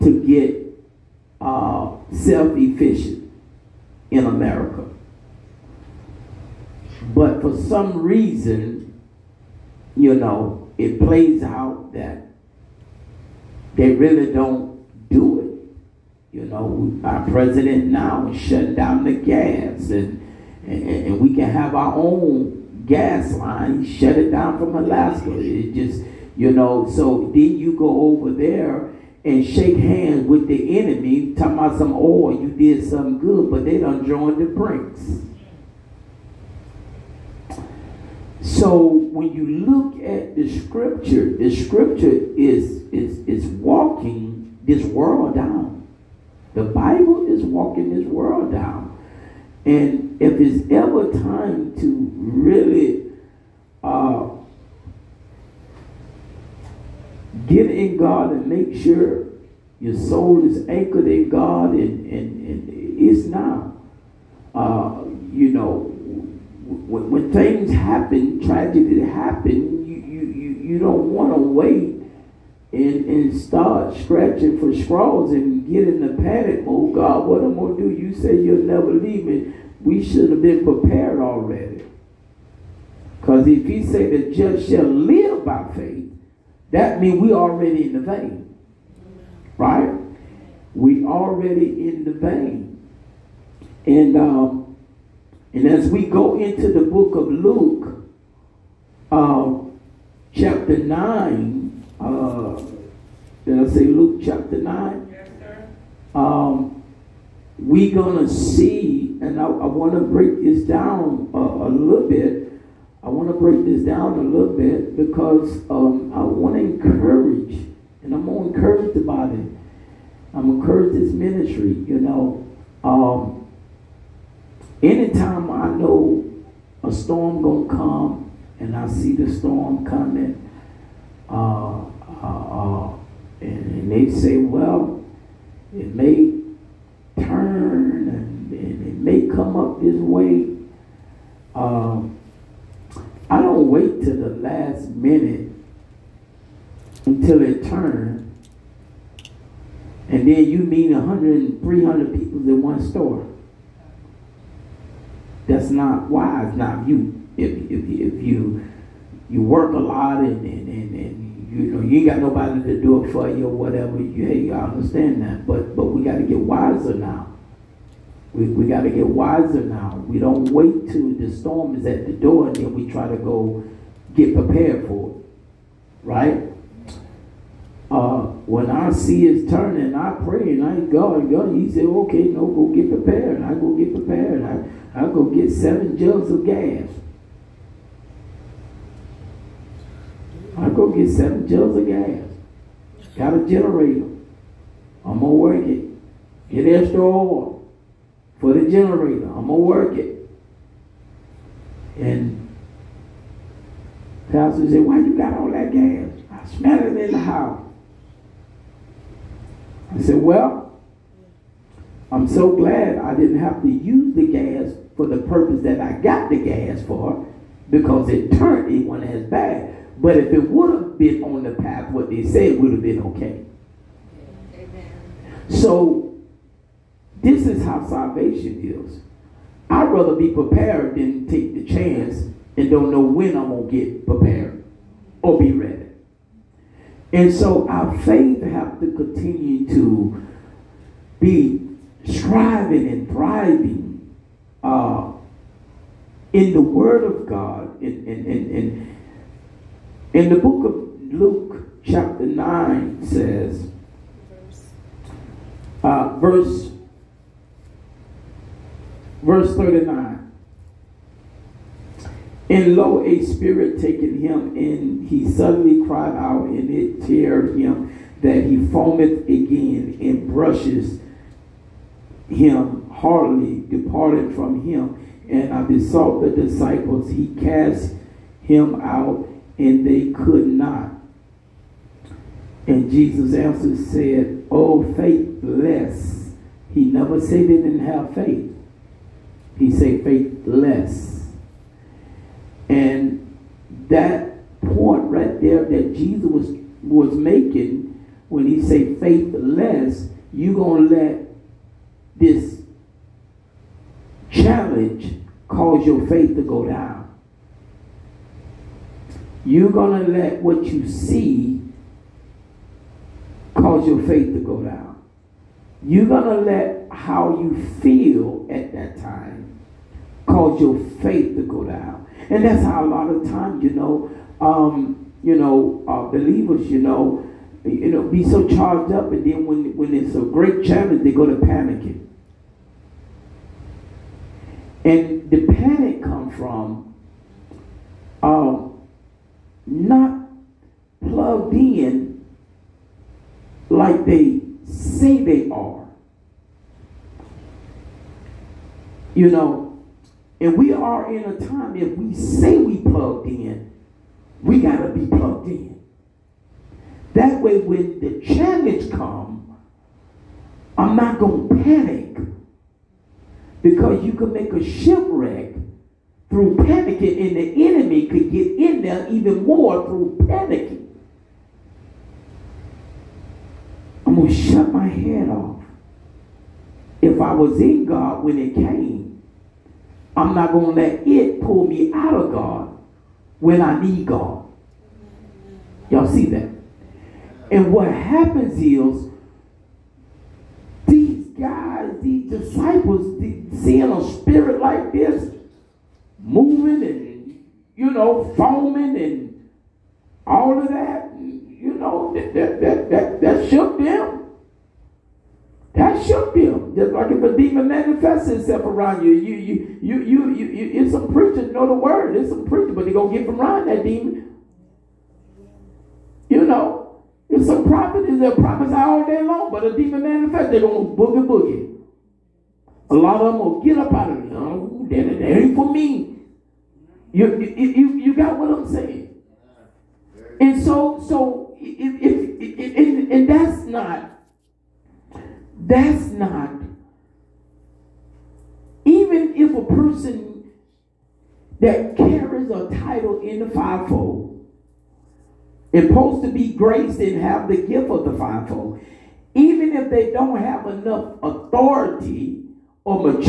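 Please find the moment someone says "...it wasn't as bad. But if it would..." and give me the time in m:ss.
3:38.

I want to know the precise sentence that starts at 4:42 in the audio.
And Jesus answered, said, O faithless.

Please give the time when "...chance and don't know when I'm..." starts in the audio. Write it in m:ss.
3:51.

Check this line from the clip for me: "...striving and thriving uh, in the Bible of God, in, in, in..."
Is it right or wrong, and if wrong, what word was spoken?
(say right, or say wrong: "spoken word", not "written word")
wrong: "Word", not "Bible".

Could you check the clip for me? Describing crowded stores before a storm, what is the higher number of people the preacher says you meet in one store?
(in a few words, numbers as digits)
300.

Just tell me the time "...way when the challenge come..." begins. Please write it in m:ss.
5:57.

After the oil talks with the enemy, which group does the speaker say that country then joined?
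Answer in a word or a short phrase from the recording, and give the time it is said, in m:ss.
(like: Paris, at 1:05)
BRICS, at 0:34.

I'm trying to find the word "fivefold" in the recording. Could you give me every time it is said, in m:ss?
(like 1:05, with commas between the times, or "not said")
7:23, 7:28.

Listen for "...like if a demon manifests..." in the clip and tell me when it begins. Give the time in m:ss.
6:46.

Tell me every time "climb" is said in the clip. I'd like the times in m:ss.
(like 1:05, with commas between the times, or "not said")
not said.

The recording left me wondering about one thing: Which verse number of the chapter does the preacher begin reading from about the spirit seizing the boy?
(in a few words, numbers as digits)
39.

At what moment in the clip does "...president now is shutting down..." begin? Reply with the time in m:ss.
0:17.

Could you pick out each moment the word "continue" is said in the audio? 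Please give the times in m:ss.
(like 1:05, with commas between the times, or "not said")
3:58.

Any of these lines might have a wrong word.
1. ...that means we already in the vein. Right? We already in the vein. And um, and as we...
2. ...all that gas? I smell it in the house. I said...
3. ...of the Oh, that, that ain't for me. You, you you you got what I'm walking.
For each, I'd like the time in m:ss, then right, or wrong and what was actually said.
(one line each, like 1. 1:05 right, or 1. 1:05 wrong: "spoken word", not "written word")
1. 1:26 right
2. 3:25 right
3. 7:04 wrong: "saying", not "walking".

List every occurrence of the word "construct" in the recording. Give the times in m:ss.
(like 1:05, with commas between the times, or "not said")
not said.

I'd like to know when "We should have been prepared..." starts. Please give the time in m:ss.
1:19.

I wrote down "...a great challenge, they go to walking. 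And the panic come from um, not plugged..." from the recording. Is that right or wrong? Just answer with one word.
wrong.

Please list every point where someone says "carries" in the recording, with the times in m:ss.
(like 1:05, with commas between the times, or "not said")
7:21.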